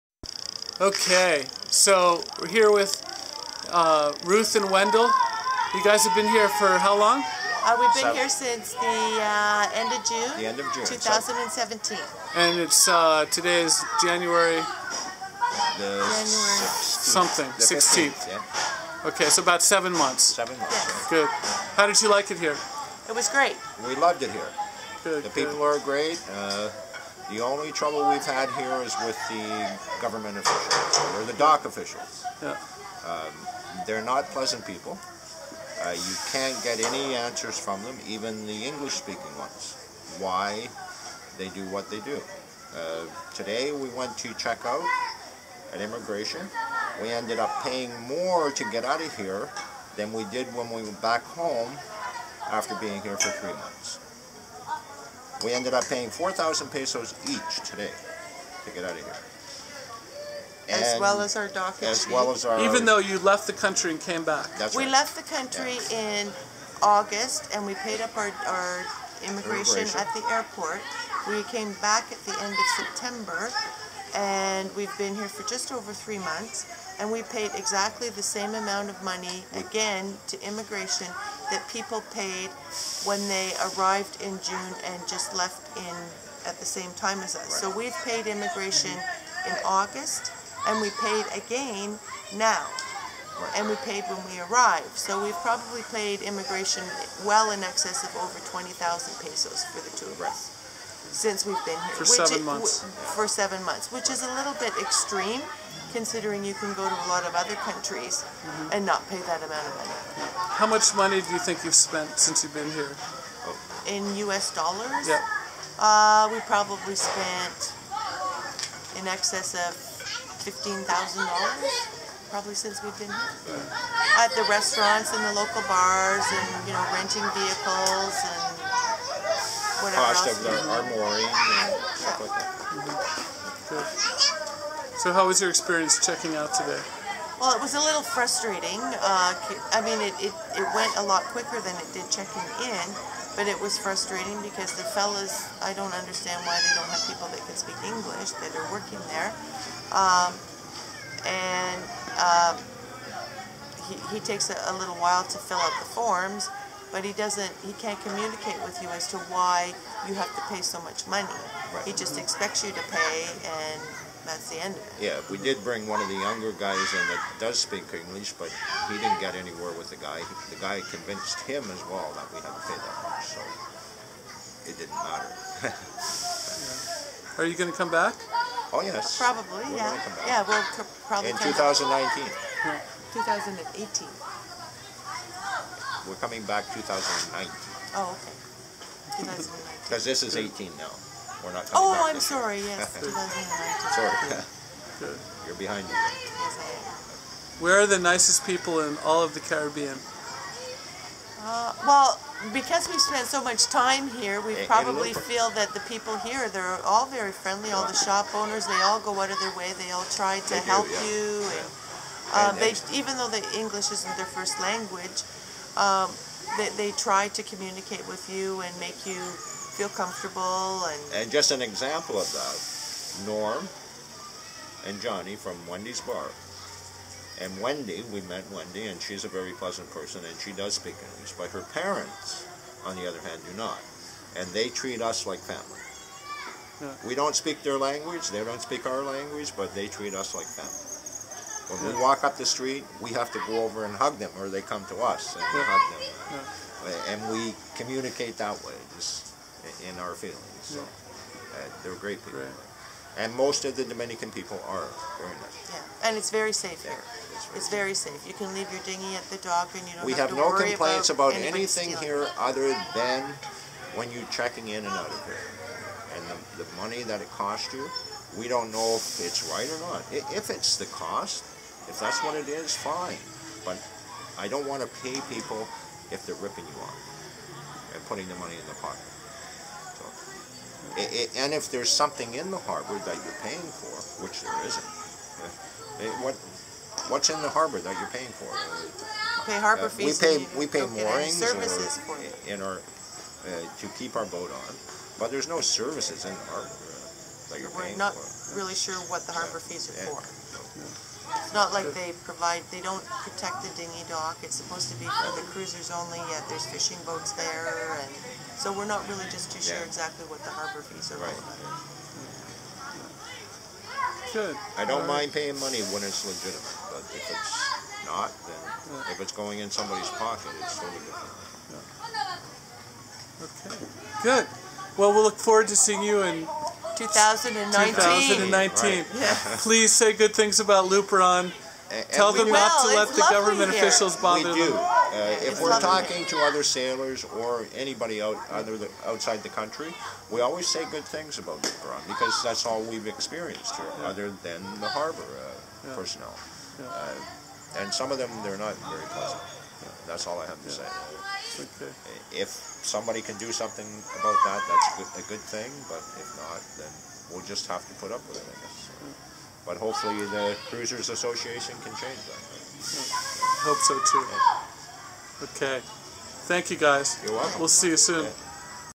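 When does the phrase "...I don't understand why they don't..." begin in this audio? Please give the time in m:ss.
2:25.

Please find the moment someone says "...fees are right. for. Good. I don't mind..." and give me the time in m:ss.
5:10.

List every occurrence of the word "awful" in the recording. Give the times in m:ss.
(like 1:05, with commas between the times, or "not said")
not said.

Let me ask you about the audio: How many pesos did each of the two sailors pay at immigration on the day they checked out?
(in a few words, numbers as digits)
4,000 pesos.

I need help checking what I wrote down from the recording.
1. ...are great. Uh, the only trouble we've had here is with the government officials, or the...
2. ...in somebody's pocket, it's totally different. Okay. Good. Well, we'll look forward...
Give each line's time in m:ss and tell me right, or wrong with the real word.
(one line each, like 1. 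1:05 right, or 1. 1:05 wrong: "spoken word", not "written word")
1. 0:25 right
2. 5:19 right.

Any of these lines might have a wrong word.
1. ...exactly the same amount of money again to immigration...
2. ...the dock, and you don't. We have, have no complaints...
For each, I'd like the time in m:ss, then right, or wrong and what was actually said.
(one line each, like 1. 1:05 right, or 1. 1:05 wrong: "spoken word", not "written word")
1. 1:17 right
2. 4:19 right.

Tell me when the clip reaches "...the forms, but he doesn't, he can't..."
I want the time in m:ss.
2:35.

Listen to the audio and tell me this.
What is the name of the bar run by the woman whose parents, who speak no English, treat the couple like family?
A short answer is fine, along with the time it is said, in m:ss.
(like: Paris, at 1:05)
Wendy's bar, at 3:45.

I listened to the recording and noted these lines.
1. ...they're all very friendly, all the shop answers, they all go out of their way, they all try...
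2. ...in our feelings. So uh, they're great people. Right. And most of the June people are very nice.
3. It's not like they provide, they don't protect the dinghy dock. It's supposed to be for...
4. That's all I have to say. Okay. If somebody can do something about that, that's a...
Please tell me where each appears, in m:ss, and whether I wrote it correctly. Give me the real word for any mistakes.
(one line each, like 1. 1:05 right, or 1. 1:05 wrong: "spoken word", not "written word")
1. 3:26 wrong: "owners", not "answers"
2. 4:09 wrong: "Dominican", not "June"
3. 5:01 right
4. 5:50 right.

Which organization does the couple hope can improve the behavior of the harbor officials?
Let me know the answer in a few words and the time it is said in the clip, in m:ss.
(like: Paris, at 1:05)
Cruisers Association, at 6:00.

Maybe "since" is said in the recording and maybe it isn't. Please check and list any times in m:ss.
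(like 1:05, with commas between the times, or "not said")
0:08, 1:41, 1:52, 2:02.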